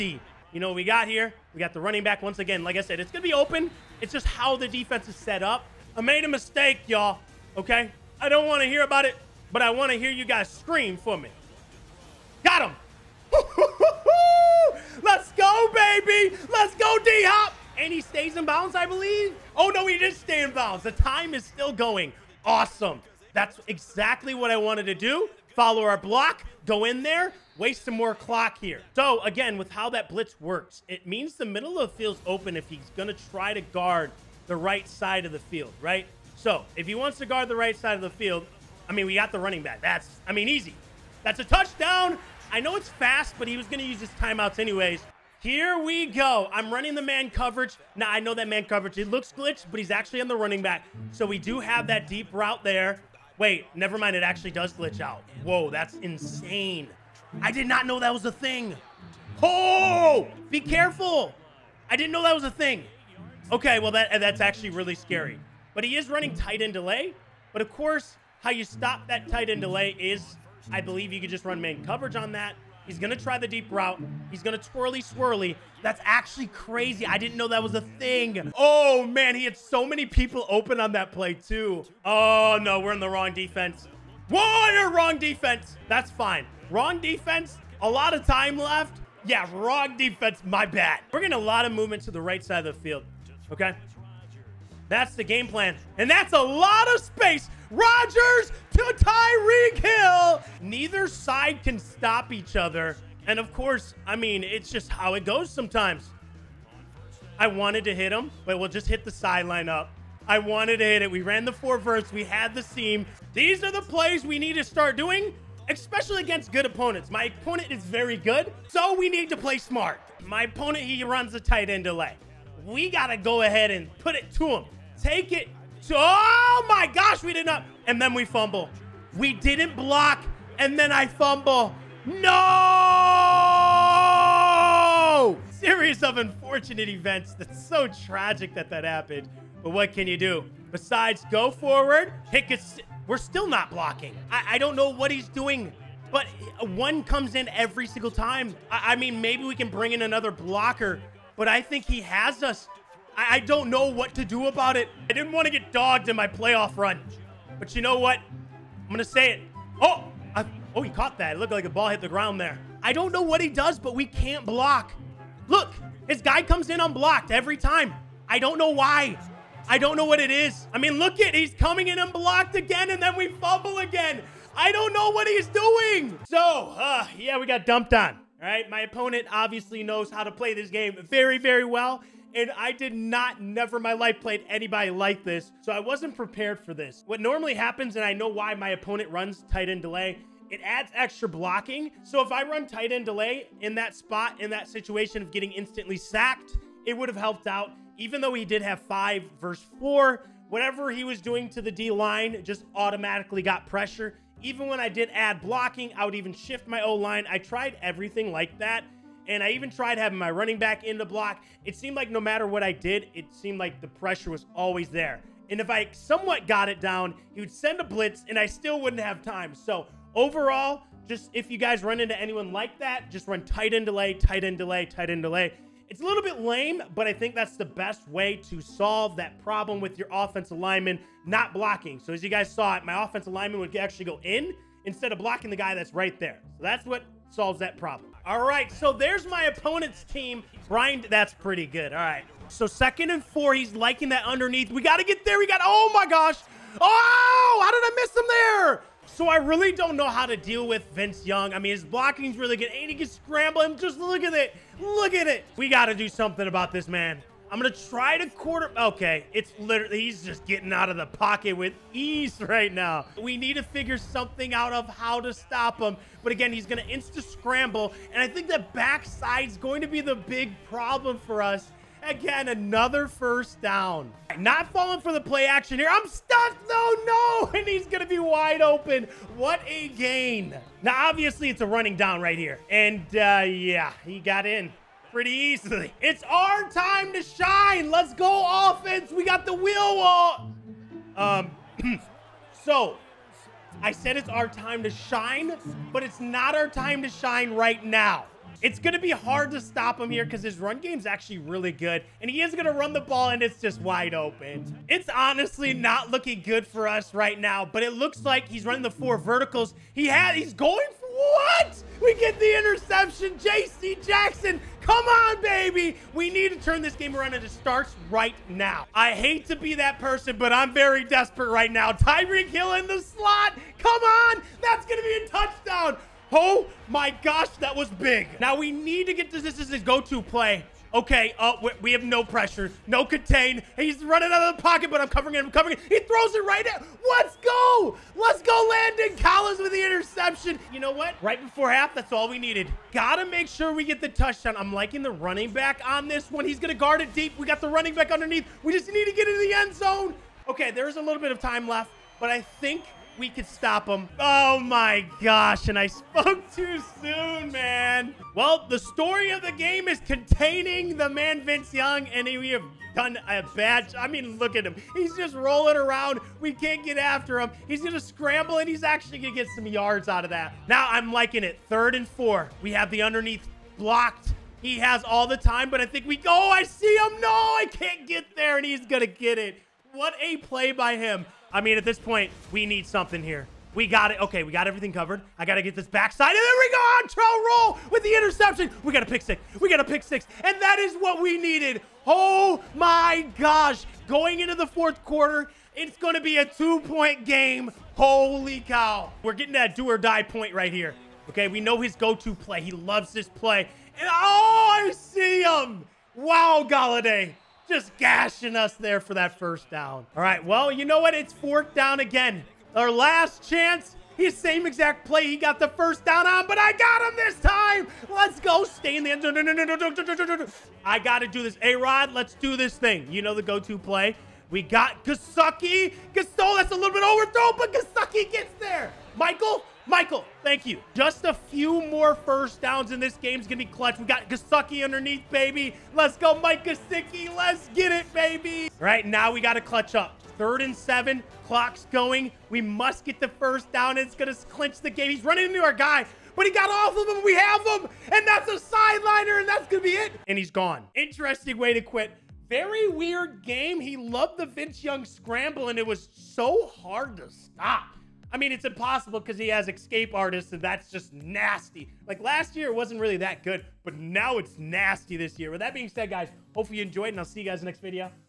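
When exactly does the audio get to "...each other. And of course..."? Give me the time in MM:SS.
01:42.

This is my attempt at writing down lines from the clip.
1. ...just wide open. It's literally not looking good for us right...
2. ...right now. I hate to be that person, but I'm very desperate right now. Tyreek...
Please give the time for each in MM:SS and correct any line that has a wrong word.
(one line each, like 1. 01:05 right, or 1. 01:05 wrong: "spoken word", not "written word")
1. 05:03 wrong: "honestly", not "literally"
2. 05:18 right.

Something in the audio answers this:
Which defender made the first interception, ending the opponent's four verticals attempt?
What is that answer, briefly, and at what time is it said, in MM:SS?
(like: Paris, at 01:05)
J.C. Jackson, at 05:13.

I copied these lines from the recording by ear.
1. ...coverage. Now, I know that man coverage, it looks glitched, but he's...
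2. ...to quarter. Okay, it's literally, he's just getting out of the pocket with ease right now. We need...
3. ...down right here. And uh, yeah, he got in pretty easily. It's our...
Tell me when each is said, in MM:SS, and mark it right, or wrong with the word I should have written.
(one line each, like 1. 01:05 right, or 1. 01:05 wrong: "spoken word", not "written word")
1. 00:47 right
2. 04:18 right
3. 04:41 right.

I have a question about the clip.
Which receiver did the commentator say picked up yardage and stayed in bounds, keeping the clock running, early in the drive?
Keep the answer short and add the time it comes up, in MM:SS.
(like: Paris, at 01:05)
D Hop, at 00:17.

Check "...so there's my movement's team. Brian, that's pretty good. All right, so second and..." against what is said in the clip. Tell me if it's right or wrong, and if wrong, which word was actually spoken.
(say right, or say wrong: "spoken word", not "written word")
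wrong: "opponent", not "movement".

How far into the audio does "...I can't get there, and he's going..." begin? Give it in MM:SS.
06:17.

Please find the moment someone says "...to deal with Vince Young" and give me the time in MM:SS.
04:10.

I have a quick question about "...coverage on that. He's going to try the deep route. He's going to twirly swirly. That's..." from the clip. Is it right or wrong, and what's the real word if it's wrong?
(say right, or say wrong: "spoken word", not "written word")
right.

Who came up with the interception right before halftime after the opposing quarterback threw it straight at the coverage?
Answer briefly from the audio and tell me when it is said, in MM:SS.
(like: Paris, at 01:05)
Landon Collins, at 05:38.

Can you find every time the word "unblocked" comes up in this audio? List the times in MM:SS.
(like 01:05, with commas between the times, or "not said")
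02:46, 02:51.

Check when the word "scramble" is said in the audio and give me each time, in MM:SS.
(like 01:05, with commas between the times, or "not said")
04:13, 04:27, 06:08, 07:35.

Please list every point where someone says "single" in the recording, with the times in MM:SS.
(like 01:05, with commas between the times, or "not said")
02:27.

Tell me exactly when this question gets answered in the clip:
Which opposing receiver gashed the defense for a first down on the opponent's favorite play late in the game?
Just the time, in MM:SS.
06:46.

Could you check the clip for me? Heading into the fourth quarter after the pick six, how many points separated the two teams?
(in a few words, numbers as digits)
2.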